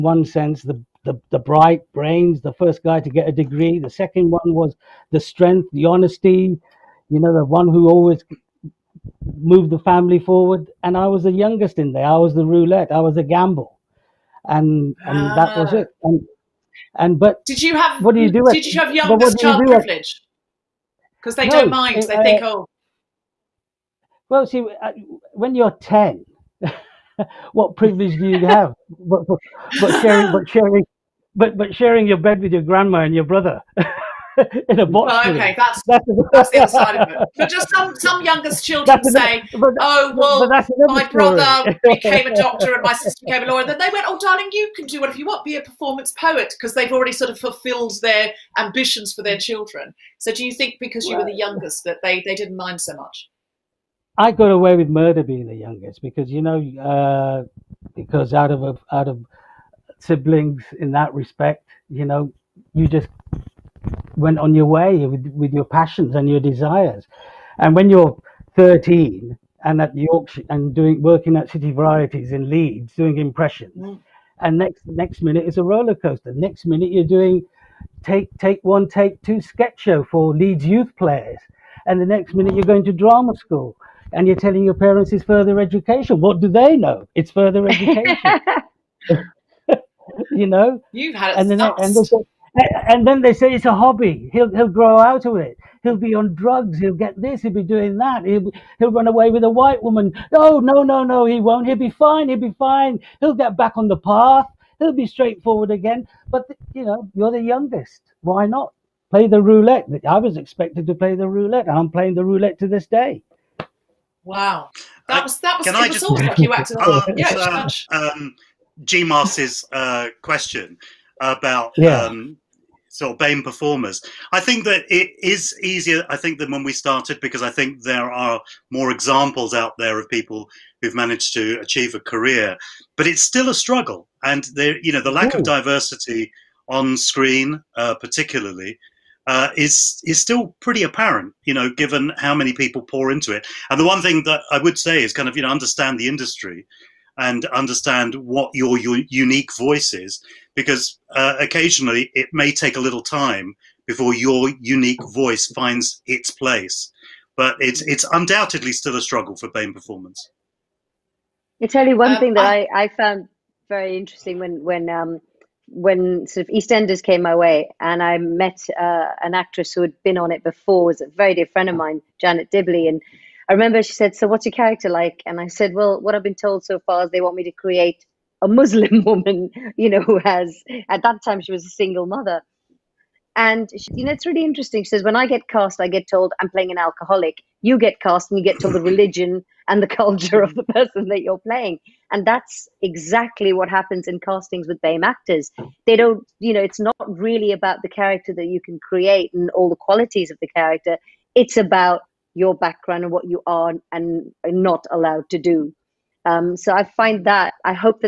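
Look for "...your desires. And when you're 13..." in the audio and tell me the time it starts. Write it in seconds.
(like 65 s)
66 s.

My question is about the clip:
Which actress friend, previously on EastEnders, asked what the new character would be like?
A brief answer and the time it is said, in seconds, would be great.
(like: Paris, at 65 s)
Janet Dibley, at 172 s.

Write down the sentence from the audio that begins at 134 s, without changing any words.
And there, you know, the lack Ooh.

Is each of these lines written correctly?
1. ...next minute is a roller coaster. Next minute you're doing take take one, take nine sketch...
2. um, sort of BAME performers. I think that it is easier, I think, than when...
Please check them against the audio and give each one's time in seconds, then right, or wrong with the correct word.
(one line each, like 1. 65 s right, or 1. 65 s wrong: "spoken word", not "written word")
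1. 74 s wrong: "two", not "nine"
2. 122 s right.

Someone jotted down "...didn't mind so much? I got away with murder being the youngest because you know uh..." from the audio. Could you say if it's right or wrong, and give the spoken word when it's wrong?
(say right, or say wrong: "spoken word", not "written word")
right.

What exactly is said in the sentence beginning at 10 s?
And I was the youngest in there.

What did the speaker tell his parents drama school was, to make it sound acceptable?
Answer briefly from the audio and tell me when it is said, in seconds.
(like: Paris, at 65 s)
Further education, at 85 s.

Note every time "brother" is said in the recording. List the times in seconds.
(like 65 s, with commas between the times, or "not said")
33 s, 41 s.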